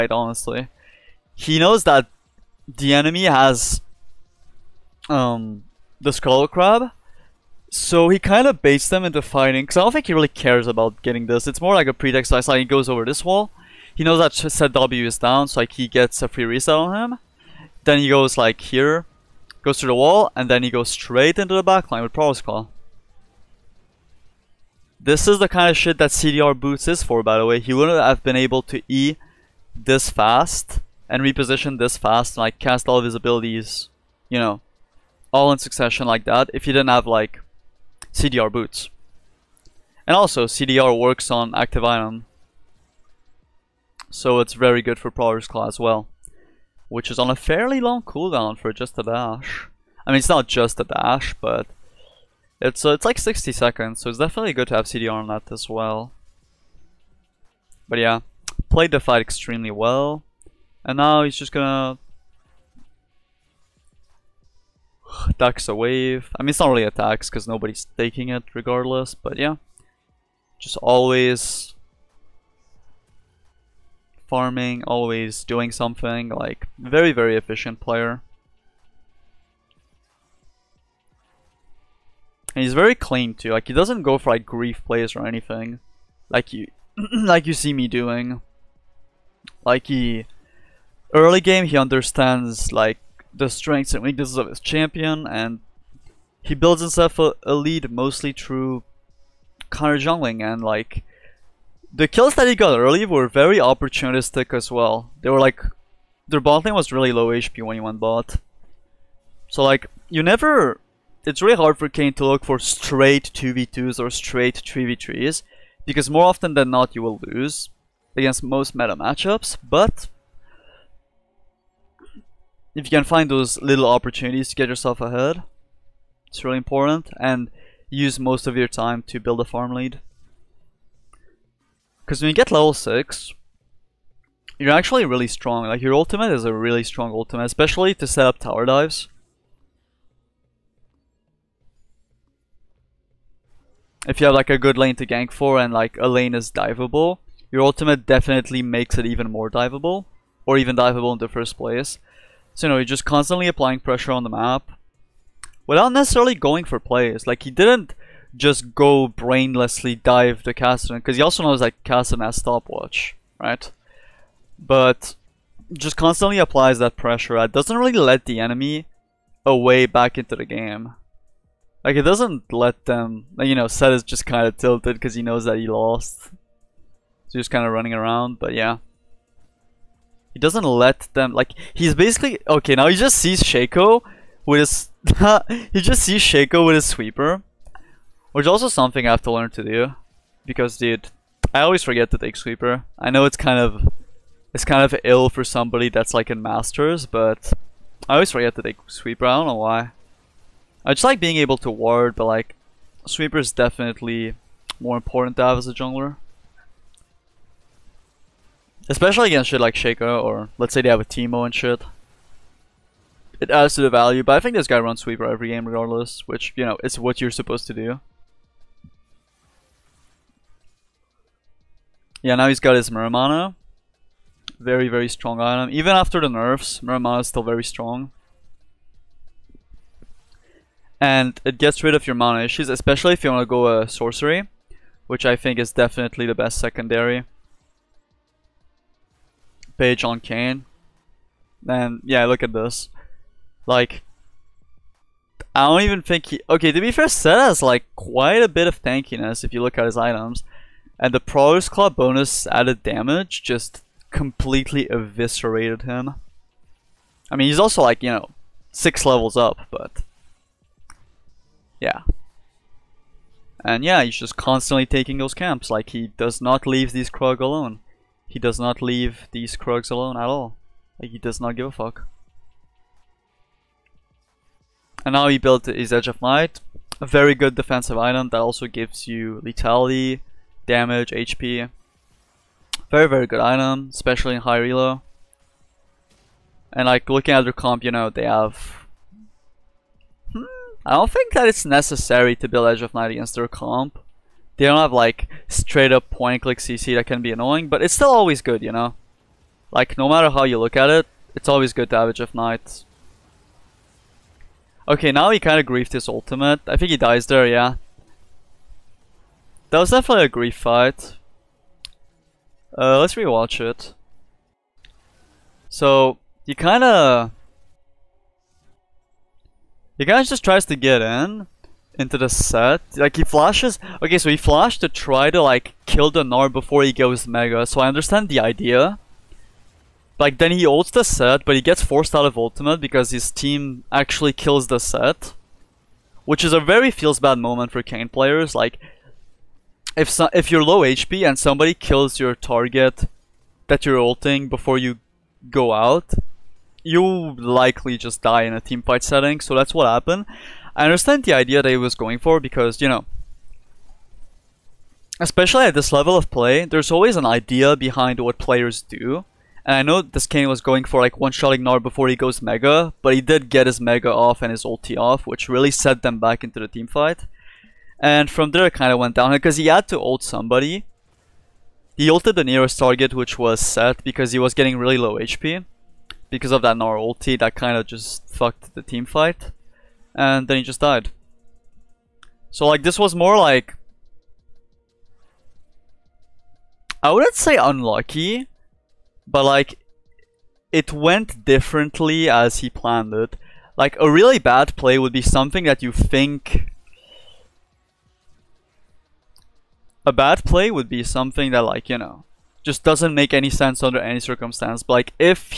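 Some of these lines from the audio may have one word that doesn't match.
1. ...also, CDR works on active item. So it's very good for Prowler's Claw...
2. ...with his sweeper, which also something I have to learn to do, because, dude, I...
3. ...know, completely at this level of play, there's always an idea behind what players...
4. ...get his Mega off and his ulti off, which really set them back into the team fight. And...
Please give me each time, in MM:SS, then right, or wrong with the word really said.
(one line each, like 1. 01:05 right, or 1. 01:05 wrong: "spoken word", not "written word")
1. 00:40 right
2. 03:06 right
3. 05:52 wrong: "especially", not "completely"
4. 06:03 right.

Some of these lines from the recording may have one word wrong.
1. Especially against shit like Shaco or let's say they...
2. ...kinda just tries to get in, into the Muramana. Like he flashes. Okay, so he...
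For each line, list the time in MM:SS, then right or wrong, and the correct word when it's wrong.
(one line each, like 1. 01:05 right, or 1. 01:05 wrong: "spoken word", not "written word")
1. 03:28 right
2. 05:20 wrong: "Sett", not "Muramana".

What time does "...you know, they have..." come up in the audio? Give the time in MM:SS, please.
04:47.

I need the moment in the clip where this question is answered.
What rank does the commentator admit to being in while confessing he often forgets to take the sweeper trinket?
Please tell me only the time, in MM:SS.
03:16.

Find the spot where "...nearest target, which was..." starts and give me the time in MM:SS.
06:12.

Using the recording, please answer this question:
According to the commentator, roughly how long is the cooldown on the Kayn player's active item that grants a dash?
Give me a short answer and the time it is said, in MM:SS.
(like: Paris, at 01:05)
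60 seconds, at 00:53.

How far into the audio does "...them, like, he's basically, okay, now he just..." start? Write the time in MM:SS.
03:01.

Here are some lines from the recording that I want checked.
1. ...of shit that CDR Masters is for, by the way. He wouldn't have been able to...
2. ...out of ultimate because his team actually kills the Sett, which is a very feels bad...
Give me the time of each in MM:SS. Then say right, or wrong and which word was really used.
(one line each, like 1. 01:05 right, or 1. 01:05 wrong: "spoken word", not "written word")
1. 00:25 wrong: "Boots", not "Masters"
2. 05:32 right.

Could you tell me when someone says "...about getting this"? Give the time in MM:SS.
00:10.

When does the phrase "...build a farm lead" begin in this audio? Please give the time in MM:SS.
02:09.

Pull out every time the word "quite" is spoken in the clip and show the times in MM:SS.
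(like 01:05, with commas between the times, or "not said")
04:07.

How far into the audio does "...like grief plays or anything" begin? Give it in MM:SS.
01:24.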